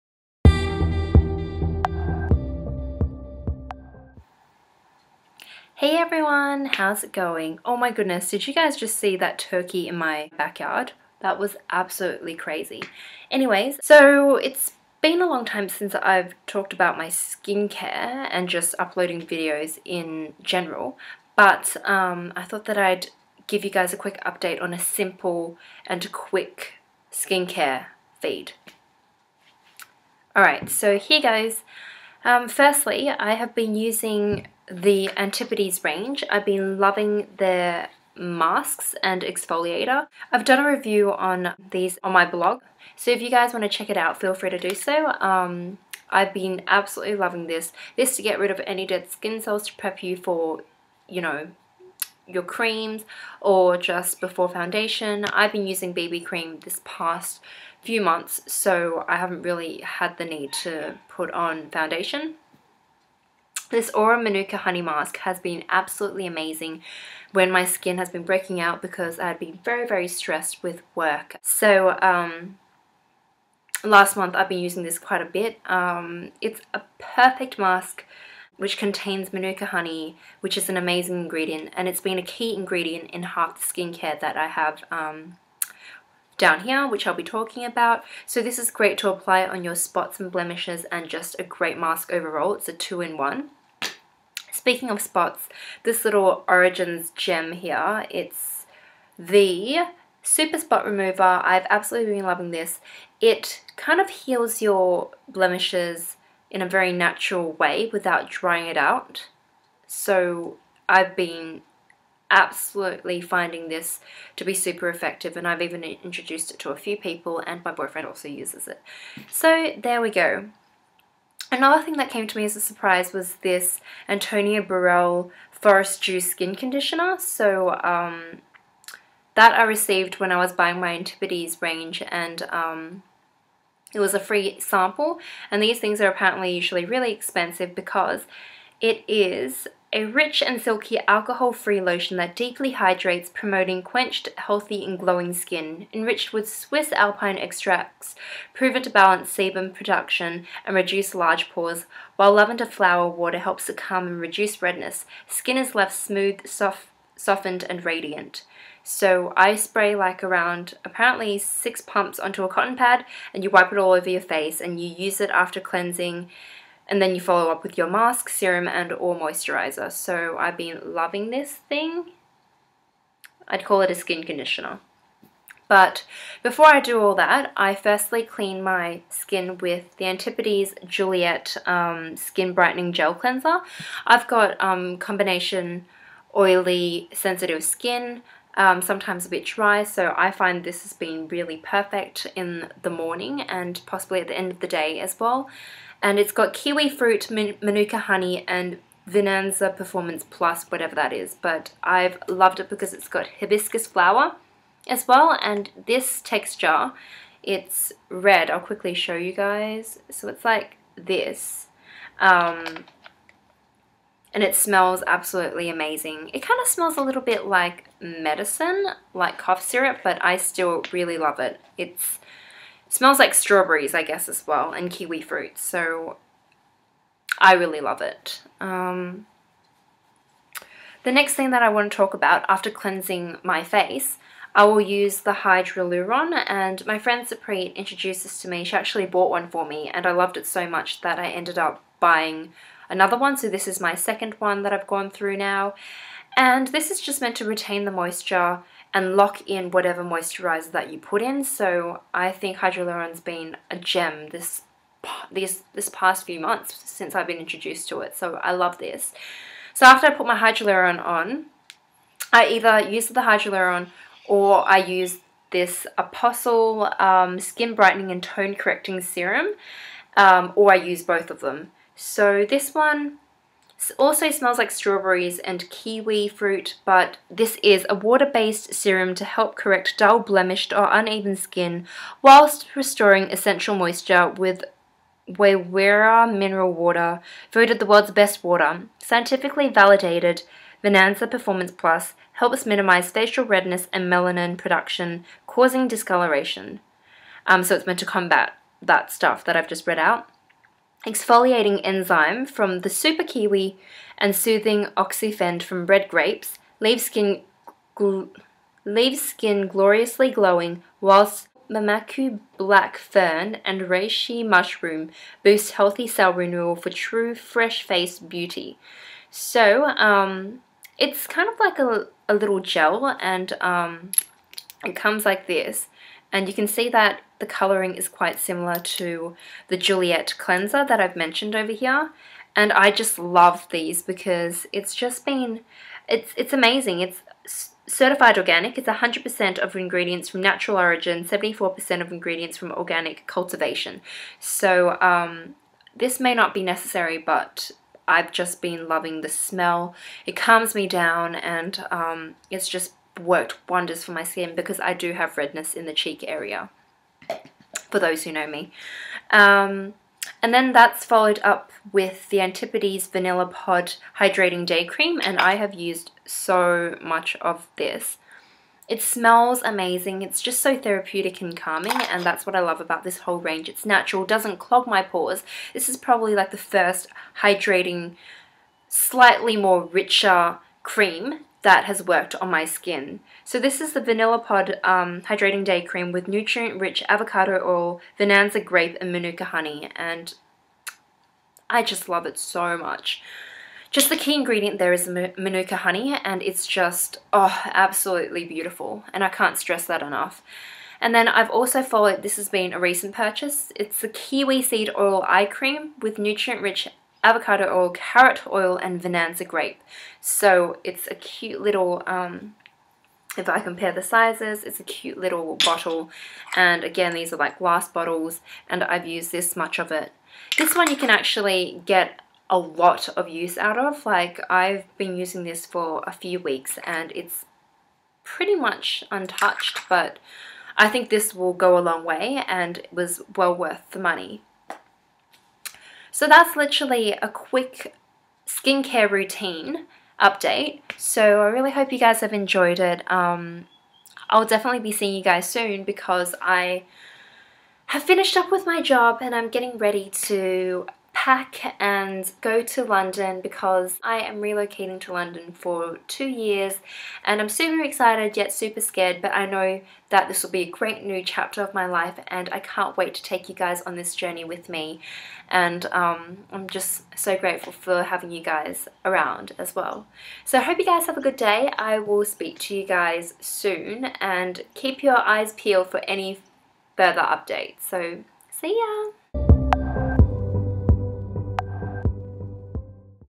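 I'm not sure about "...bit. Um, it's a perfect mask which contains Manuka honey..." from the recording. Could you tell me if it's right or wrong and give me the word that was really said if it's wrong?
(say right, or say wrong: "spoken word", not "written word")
right.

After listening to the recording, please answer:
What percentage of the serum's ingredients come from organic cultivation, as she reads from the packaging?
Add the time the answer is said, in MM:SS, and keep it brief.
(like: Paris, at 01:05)
74%, at 05:41.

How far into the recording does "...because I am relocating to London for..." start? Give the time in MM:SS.
07:33.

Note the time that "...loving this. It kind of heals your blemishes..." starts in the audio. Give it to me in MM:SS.
01:42.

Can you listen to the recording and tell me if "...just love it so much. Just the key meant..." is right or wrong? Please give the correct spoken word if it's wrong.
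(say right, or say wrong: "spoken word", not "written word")
wrong: "ingredient", not "meant".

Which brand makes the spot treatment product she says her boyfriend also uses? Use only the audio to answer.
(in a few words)
Origins.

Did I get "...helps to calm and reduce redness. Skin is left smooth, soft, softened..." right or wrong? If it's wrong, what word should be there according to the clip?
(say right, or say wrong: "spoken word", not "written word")
right.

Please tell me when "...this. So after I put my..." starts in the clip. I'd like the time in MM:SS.
04:18.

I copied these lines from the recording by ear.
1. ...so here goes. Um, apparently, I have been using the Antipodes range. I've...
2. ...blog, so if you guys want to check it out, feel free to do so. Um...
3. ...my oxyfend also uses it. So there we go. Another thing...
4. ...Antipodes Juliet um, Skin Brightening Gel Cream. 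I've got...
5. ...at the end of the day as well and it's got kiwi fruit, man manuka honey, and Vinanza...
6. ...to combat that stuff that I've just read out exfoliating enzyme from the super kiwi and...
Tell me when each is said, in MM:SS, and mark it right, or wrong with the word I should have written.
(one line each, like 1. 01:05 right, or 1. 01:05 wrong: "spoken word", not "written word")
1. 00:30 wrong: "firstly", not "apparently"
2. 00:42 right
3. 01:57 wrong: "boyfriend", not "oxyfend"
4. 03:00 wrong: "Cleanser", not "Cream"
5. 03:14 right
6. 04:57 right.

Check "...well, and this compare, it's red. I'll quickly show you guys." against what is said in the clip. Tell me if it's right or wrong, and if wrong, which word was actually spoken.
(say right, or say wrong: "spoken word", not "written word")
wrong: "texture", not "compare".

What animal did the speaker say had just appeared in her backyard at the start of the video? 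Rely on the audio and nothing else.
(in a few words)
turkey.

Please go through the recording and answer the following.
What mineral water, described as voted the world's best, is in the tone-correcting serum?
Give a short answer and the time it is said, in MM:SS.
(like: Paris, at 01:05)
Waiwera, at 04:45.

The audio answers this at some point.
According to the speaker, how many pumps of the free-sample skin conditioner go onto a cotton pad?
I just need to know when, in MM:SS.
02:41.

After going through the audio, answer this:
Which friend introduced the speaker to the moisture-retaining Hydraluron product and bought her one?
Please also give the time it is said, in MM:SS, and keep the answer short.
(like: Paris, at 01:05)
Sapri, at 03:57.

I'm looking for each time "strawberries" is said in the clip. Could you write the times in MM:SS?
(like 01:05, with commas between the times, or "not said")
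03:43, 04:34.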